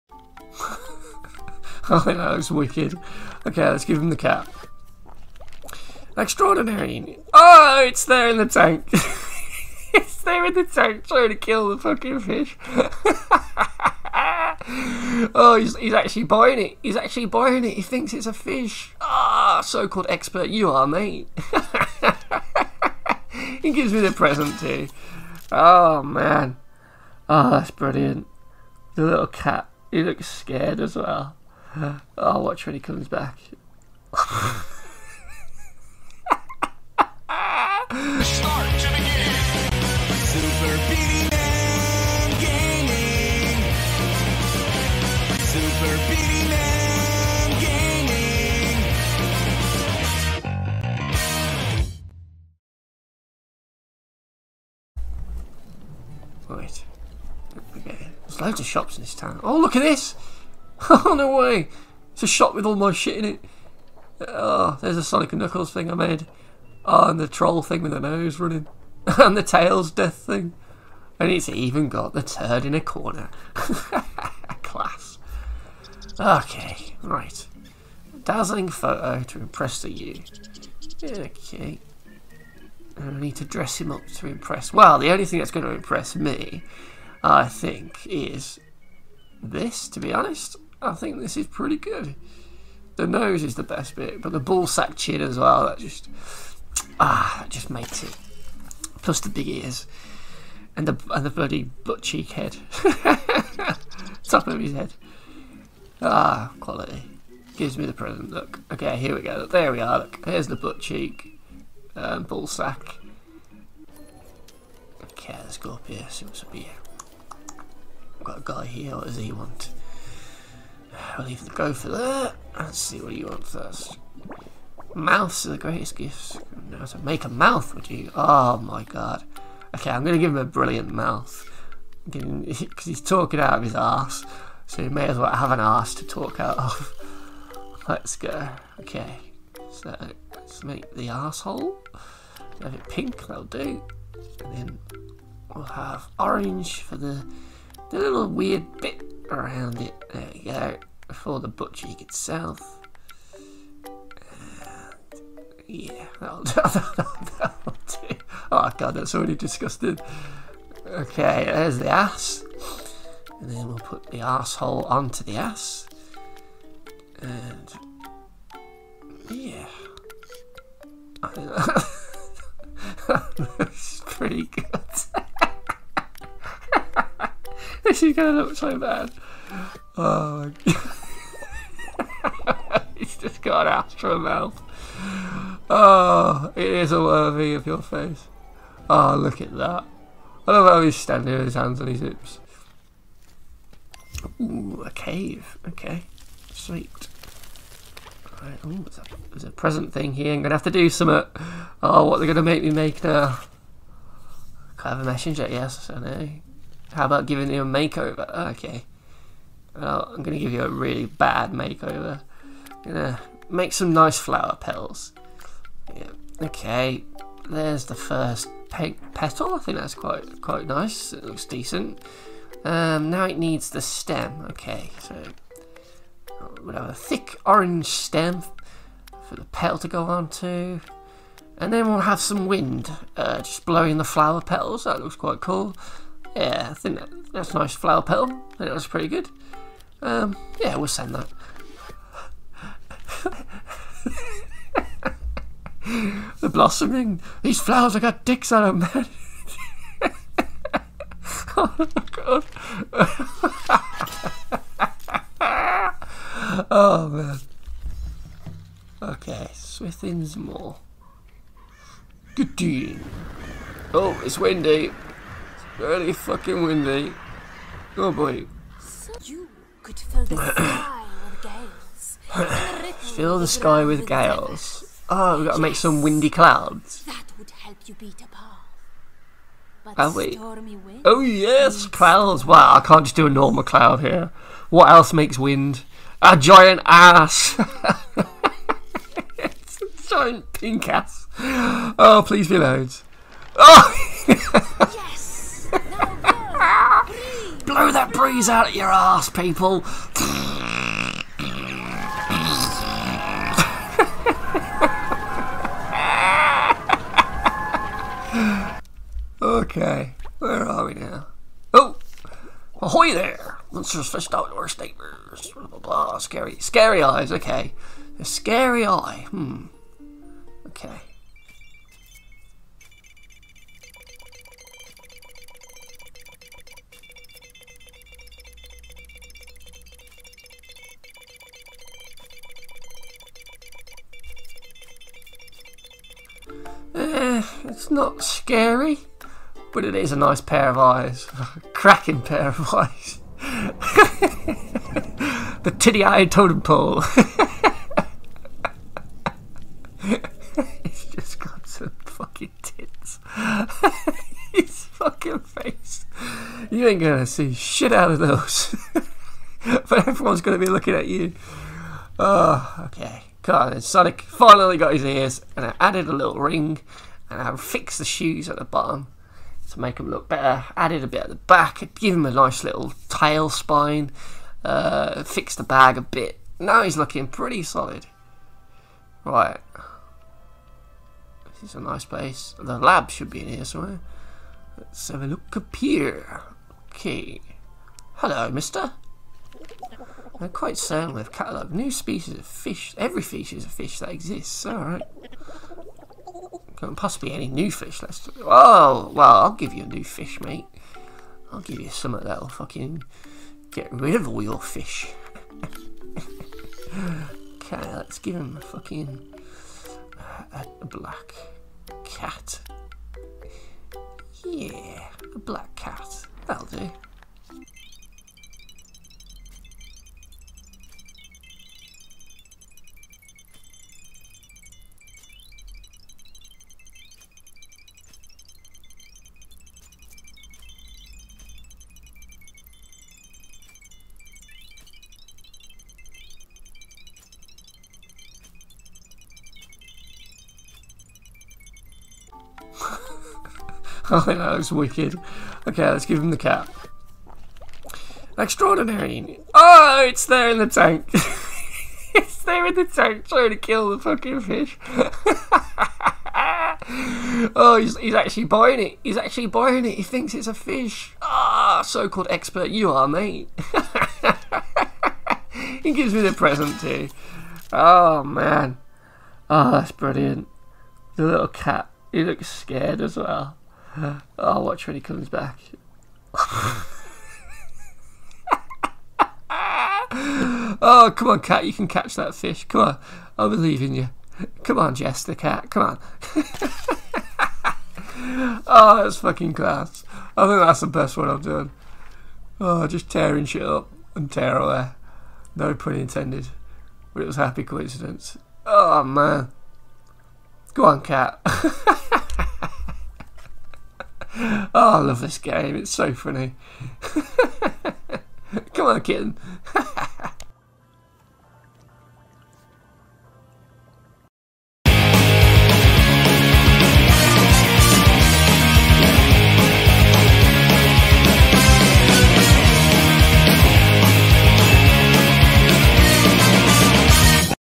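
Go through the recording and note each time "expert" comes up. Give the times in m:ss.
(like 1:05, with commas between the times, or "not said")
0:20, 7:42.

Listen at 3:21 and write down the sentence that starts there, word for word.
Uh, oh, what they're gonna make me make now?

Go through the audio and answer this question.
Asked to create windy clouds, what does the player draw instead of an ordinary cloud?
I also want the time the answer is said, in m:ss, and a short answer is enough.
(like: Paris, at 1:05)
A giant pink ass, at 4:49.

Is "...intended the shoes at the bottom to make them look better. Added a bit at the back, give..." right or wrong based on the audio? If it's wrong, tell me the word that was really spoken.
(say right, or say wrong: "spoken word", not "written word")
wrong: "fixed", not "intended".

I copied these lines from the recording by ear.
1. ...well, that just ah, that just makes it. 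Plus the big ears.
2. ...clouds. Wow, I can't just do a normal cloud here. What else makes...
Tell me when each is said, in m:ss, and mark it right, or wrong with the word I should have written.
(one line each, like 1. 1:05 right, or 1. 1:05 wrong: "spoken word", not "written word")
1. 1:35 right
2. 4:41 right.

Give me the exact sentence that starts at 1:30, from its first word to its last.
I think this is pretty good.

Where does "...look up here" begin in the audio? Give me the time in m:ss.
6:25.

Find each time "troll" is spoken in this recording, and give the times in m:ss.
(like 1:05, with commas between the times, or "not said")
1:07.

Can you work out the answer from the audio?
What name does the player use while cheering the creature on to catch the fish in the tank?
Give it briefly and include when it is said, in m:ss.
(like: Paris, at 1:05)
Jess, at 8:04.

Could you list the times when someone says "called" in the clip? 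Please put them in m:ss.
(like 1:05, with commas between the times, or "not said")
0:19, 7:41.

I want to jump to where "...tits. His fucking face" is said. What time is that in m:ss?
5:52.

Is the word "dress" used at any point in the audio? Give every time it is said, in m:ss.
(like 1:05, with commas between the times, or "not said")
1:23.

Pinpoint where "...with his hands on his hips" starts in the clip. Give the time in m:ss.
3:11.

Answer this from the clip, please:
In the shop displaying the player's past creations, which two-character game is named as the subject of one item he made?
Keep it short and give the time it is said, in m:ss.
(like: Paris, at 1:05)
Sonic and Knuckles, at 1:05.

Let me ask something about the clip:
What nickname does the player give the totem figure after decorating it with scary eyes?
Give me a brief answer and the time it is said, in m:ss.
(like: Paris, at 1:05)
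Titty eyed totem pole, at 5:45.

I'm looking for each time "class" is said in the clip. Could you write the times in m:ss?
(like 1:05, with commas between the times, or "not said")
1:13, 8:09.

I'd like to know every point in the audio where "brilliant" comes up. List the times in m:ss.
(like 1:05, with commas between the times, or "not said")
0:27, 2:10, 7:49.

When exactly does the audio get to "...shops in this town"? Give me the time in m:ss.
0:58.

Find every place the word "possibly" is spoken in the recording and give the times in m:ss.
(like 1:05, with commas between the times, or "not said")
6:36.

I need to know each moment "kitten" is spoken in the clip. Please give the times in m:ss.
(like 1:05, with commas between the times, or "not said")
8:29.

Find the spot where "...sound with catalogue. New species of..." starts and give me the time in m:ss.
6:30.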